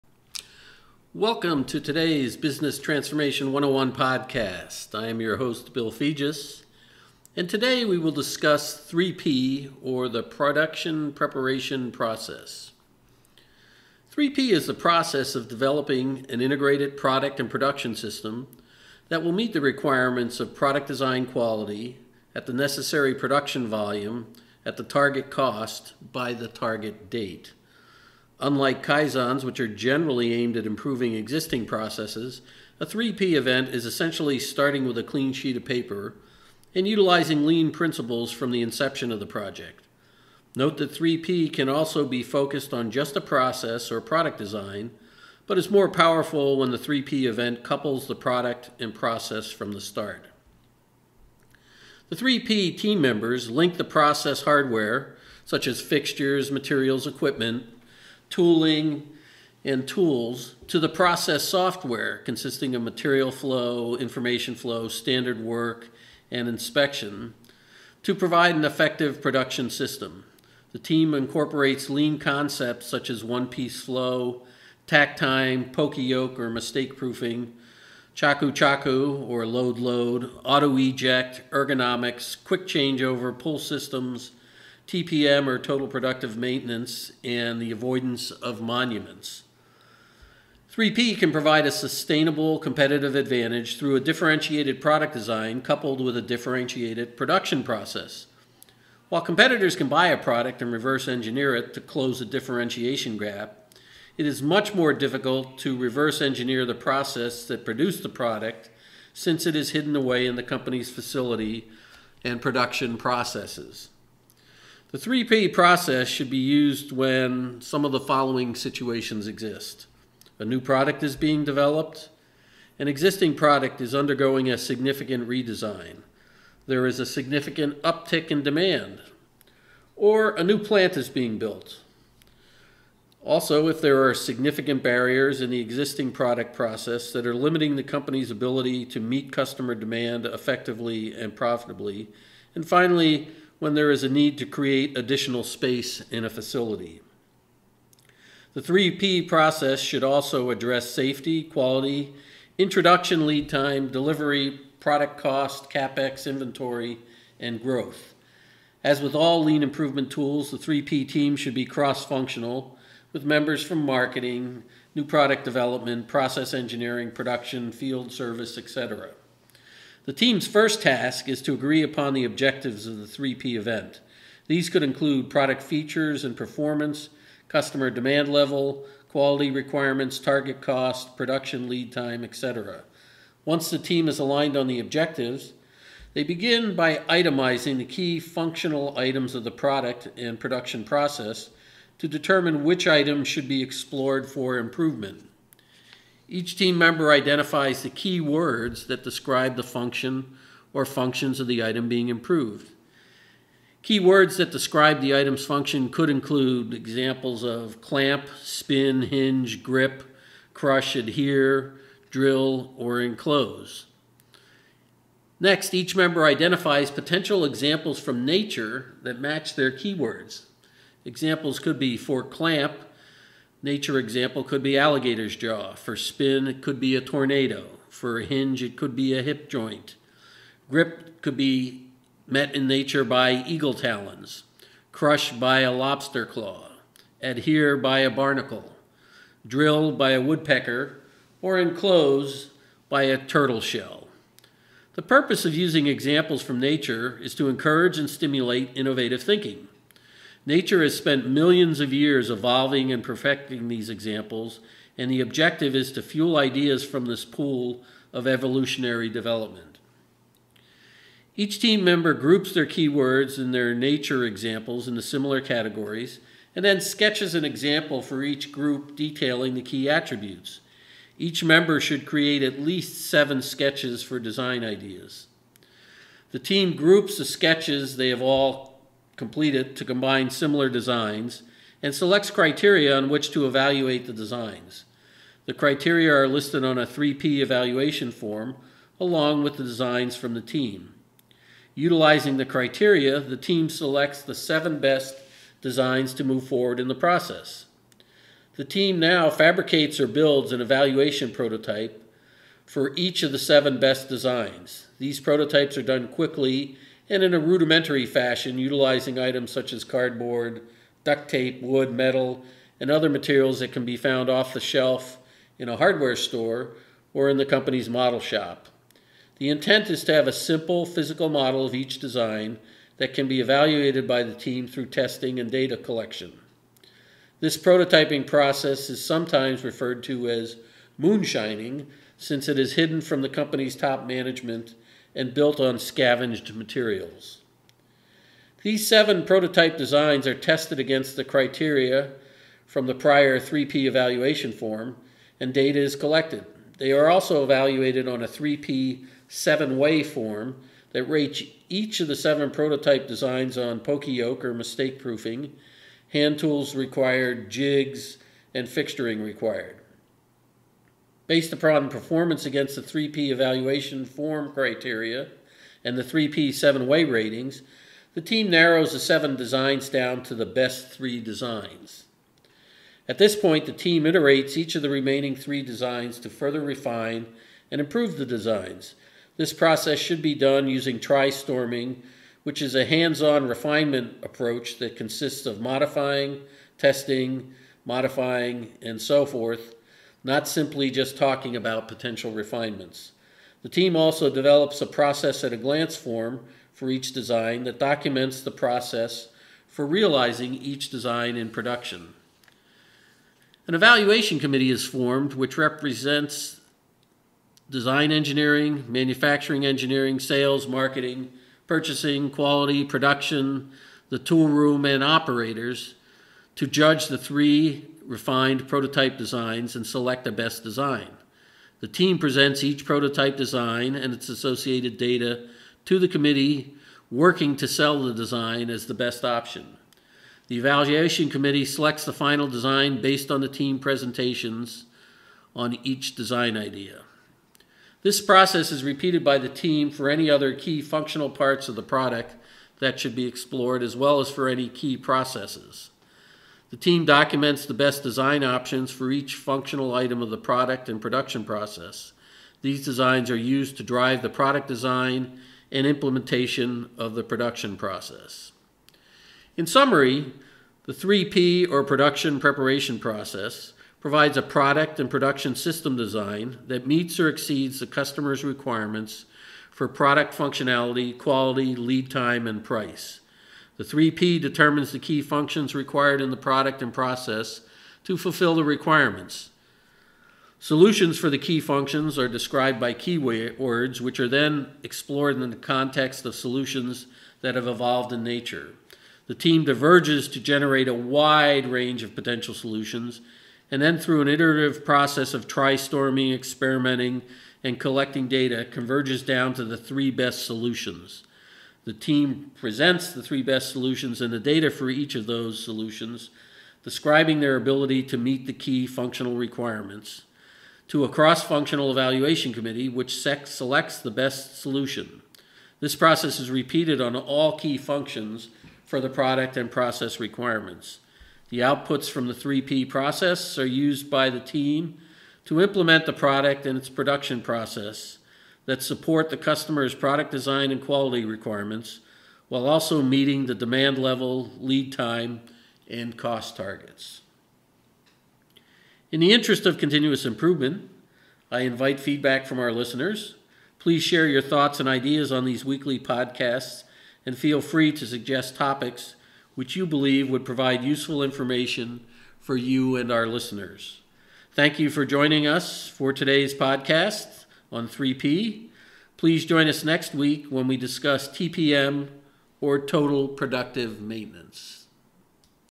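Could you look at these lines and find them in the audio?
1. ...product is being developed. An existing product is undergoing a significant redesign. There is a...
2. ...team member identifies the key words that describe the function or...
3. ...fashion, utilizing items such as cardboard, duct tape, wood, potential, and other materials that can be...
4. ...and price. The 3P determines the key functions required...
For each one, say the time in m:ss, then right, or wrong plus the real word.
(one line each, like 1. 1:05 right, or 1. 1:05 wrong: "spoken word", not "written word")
1. 2:00 right
2. 3:16 right
3. 5:08 wrong: "metal", not "potential"
4. 7:52 right.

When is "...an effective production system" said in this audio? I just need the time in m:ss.
1:08.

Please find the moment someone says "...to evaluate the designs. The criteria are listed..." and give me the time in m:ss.
4:43.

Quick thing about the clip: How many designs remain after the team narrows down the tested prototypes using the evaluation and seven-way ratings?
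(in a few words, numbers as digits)
3.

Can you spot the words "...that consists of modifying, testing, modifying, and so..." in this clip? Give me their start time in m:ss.
6:24.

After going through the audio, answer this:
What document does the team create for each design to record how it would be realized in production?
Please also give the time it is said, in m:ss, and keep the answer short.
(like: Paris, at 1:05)
Process at a glance form, at 6:34.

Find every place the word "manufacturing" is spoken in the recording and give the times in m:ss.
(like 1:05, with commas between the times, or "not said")
6:48.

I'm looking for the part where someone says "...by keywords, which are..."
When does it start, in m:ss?
8:02.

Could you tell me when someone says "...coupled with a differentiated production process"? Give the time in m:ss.
1:35.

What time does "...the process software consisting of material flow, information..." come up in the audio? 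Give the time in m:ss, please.
1:00.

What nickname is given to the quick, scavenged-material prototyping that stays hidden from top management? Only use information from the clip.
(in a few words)
Moonshining.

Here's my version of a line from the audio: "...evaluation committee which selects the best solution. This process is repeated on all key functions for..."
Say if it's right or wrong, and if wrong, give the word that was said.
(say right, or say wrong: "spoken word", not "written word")
right.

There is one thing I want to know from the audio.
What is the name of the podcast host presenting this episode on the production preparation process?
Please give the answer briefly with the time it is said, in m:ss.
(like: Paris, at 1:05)
Bill Fegis, at 0:05.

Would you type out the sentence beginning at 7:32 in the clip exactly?
These designs are used to drive the product design and implementation of the production process.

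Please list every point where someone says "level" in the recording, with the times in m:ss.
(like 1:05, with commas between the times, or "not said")
2:58, 8:53.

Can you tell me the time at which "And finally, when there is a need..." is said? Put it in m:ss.
2:22.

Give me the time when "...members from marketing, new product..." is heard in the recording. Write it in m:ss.
2:43.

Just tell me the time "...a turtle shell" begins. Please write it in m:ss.
4:03.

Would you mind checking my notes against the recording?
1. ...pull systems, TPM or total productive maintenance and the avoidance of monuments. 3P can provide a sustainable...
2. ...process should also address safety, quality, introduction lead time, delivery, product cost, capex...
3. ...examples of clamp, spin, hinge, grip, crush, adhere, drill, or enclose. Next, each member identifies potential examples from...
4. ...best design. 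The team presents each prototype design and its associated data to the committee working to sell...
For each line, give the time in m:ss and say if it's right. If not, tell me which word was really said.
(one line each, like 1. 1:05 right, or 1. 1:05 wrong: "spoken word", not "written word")
1. 1:23 right
2. 2:29 right
3. 3:26 right
4. 7:00 right.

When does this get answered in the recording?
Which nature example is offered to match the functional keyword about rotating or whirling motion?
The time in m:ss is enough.
3:47.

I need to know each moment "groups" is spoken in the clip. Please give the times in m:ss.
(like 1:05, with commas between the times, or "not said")
4:22, 4:28, 4:36.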